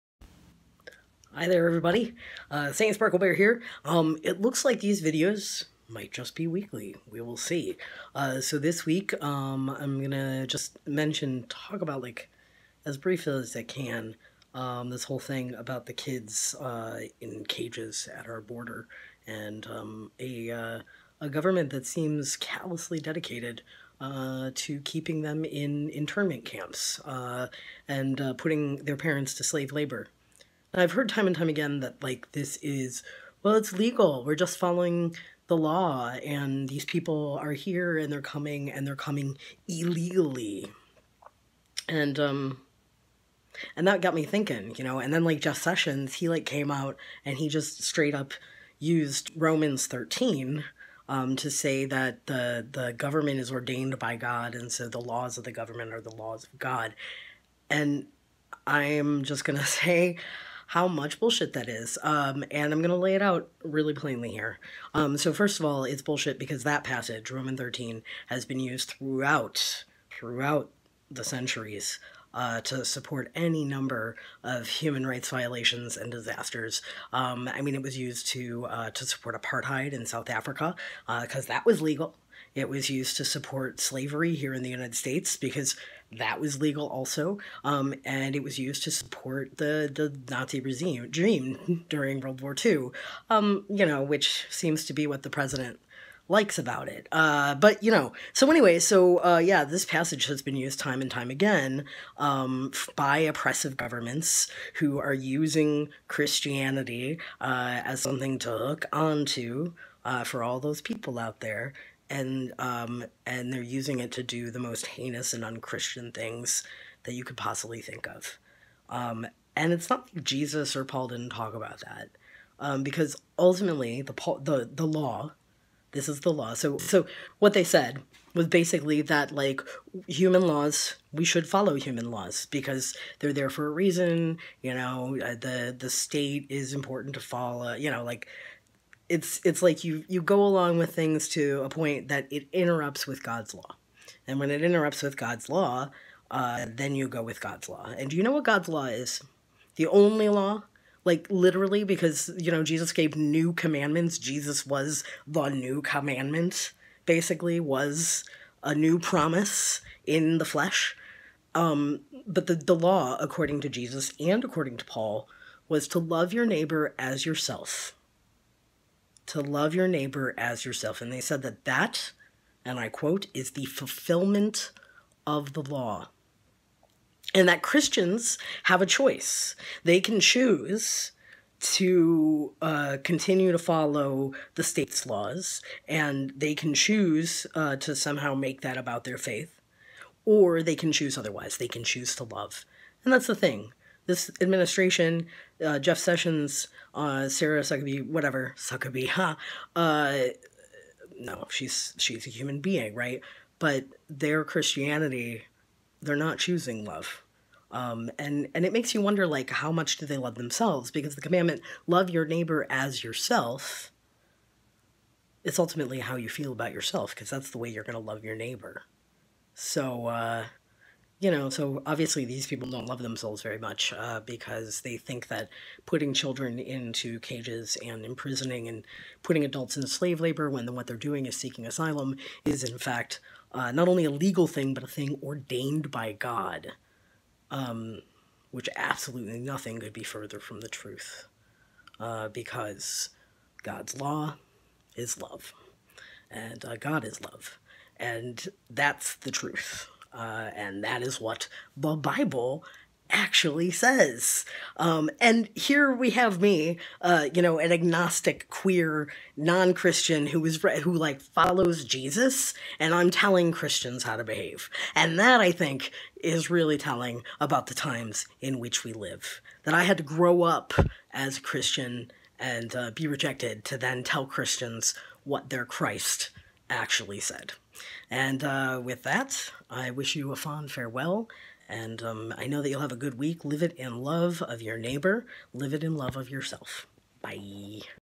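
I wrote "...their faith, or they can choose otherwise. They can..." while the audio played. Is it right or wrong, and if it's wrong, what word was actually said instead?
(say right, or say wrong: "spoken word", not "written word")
right.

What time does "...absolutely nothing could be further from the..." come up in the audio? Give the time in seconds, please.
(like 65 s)
238 s.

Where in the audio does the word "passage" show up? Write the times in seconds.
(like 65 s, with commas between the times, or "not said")
66 s, 99 s.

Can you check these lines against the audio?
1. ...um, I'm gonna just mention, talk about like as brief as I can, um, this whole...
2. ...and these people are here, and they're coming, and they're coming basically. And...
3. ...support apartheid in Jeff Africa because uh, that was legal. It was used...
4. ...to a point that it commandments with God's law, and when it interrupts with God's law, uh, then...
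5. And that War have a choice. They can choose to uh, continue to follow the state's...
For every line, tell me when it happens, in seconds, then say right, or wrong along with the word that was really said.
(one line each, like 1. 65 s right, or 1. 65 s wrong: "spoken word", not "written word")
1. 9 s right
2. 36 s wrong: "illegally", not "basically"
3. 79 s wrong: "South", not "Jeff"
4. 141 s wrong: "interrupts", not "commandments"
5. 177 s wrong: "Christians", not "War".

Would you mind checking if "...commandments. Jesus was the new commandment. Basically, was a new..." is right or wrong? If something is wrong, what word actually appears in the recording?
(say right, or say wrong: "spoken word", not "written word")
right.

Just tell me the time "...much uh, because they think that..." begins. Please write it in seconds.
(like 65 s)
223 s.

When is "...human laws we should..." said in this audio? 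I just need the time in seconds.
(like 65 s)
130 s.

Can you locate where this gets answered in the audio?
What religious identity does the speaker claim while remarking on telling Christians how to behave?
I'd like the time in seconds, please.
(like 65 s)
257 s.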